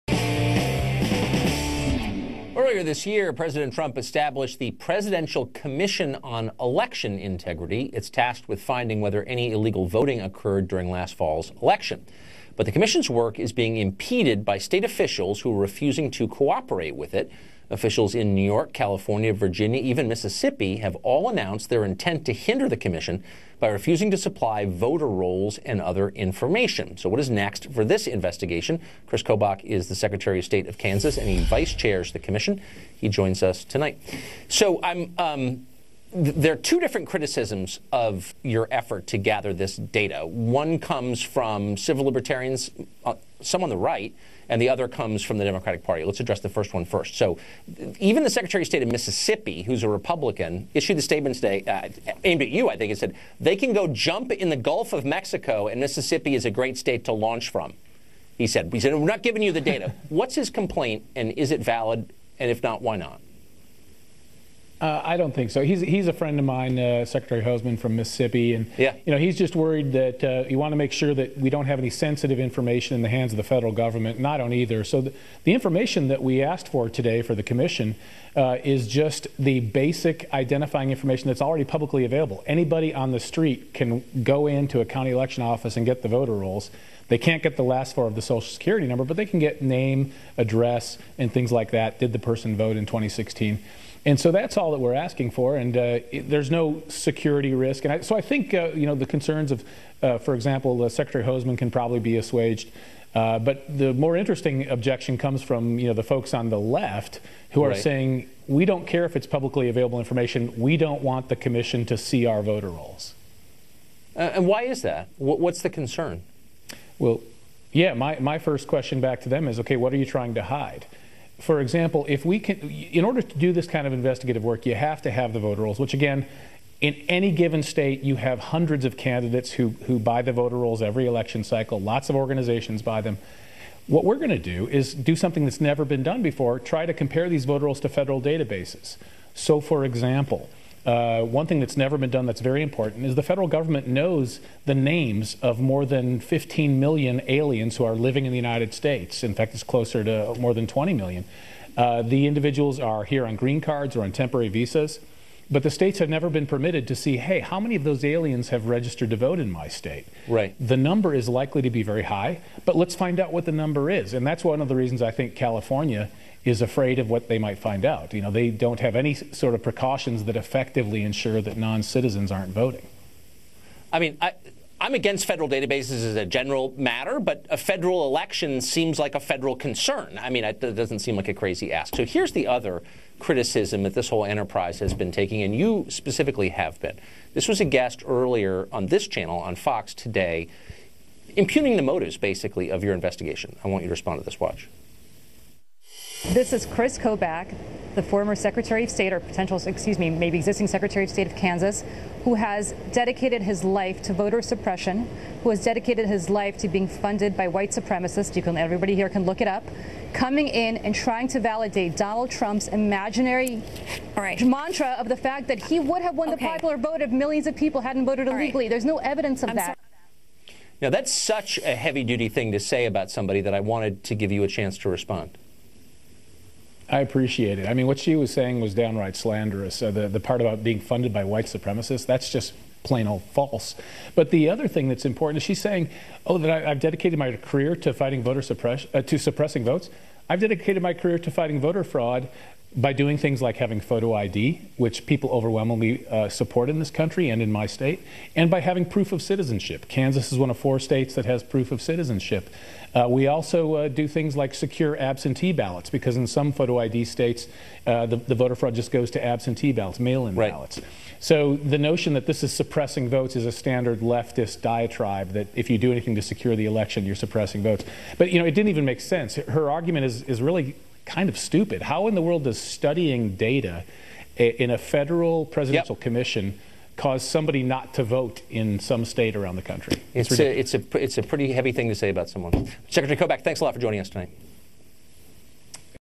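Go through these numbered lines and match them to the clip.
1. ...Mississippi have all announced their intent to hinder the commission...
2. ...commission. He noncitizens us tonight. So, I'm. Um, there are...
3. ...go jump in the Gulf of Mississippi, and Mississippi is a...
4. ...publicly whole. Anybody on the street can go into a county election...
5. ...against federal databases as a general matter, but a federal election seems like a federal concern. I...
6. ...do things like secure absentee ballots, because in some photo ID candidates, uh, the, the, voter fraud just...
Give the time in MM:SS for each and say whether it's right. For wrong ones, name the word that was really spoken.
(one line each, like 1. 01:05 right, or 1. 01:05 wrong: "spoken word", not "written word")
1. 00:20 right
2. 00:32 wrong: "joins", not "noncitizens"
3. 00:53 wrong: "Mexico", not "Mississippi"
4. 01:21 wrong: "available", not "whole"
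5. 02:54 right
6. 04:13 wrong: "states", not "candidates".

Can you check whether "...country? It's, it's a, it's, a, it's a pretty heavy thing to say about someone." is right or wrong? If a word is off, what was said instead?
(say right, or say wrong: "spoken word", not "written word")
right.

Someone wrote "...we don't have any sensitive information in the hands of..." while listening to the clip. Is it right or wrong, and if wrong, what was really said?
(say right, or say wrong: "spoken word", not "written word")
right.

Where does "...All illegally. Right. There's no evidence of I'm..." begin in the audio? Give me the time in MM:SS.
03:38.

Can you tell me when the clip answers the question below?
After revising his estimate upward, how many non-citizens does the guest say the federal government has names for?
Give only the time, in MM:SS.
02:30.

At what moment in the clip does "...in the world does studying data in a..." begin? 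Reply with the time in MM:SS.
04:32.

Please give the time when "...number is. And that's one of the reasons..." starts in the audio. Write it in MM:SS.
02:43.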